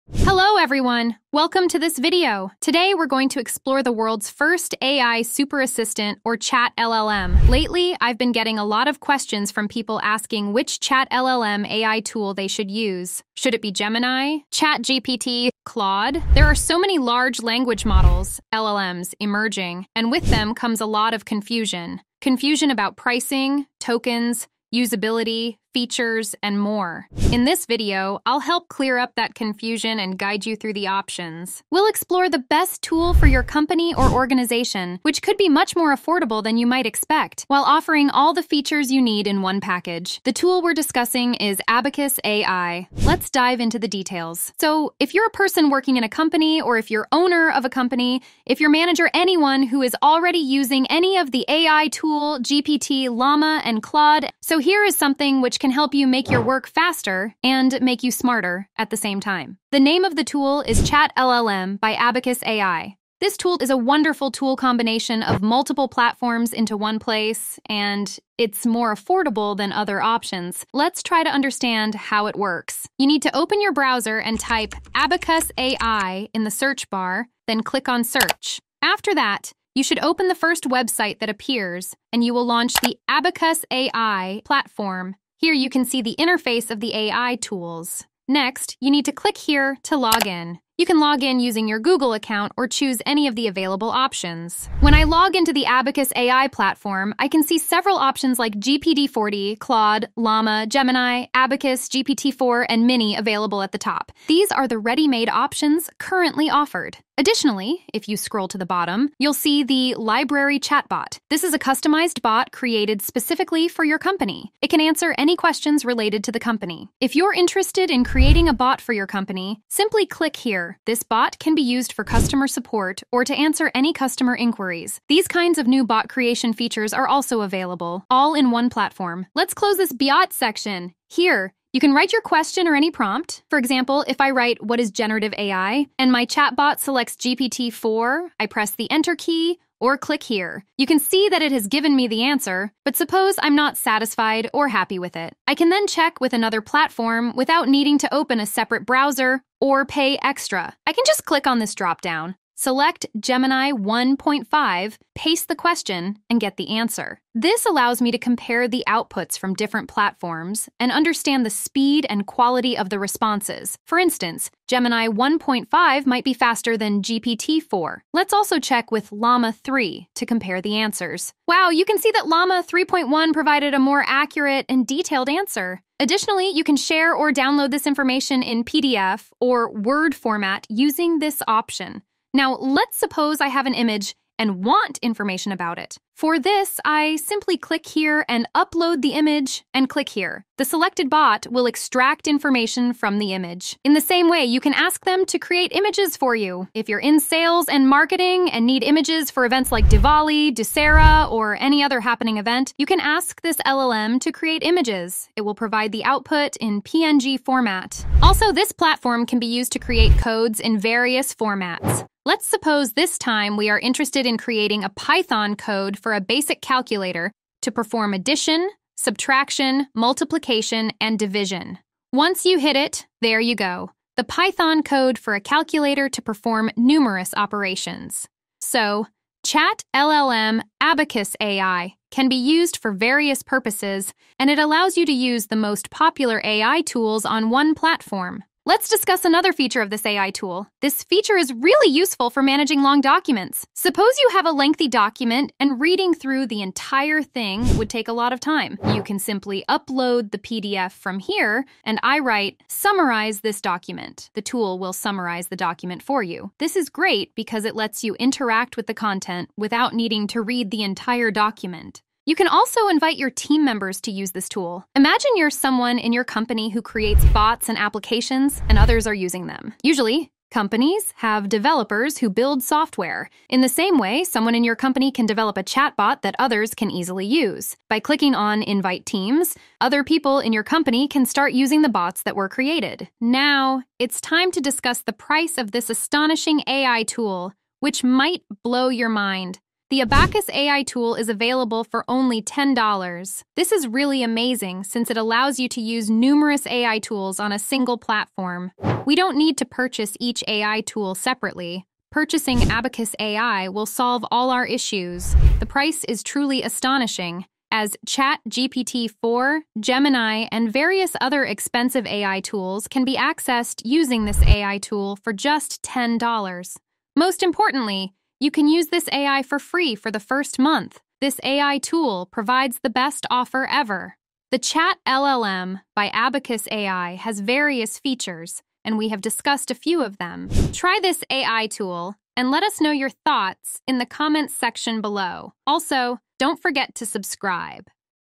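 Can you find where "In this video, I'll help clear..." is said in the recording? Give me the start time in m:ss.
0:27.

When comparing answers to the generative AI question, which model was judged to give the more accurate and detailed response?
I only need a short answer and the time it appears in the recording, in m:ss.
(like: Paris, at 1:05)
Llama 3.1, at 2:52.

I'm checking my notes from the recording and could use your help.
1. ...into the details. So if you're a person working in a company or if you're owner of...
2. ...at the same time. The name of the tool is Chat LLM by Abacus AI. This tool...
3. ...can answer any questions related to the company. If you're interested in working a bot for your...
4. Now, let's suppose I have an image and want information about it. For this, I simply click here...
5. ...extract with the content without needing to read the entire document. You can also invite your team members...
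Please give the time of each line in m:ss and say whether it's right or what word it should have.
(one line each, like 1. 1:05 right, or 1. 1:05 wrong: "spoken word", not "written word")
1. 0:43 right
2. 0:58 right
3. 1:54 wrong: "creating", not "working"
4. 3:02 right
5. 4:18 wrong: "interact", not "extract".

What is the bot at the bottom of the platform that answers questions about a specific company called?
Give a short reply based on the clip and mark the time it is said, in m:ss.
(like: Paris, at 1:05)
Library Chatbot, at 1:49.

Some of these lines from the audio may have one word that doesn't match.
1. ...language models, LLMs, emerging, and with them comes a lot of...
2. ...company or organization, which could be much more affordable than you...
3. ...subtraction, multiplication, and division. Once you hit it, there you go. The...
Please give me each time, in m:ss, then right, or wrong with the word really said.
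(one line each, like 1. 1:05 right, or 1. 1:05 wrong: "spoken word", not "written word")
1. 0:17 right
2. 0:33 right
3. 3:38 right.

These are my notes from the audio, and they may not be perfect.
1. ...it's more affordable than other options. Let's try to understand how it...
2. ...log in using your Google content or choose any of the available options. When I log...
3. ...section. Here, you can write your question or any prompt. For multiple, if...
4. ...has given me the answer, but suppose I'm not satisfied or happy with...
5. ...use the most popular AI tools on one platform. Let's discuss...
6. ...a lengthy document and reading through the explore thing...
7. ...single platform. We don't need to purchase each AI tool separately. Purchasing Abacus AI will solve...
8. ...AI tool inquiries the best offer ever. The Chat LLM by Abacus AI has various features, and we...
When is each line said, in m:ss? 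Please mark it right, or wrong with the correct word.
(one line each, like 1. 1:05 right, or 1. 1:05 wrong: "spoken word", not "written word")
1. 1:08 right
2. 1:30 wrong: "account", not "content"
3. 2:10 wrong: "example", not "multiple"
4. 2:21 right
5. 3:55 right
6. 4:04 wrong: "entire", not "explore"
7. 4:57 right
8. 5:21 wrong: "provides", not "inquiries".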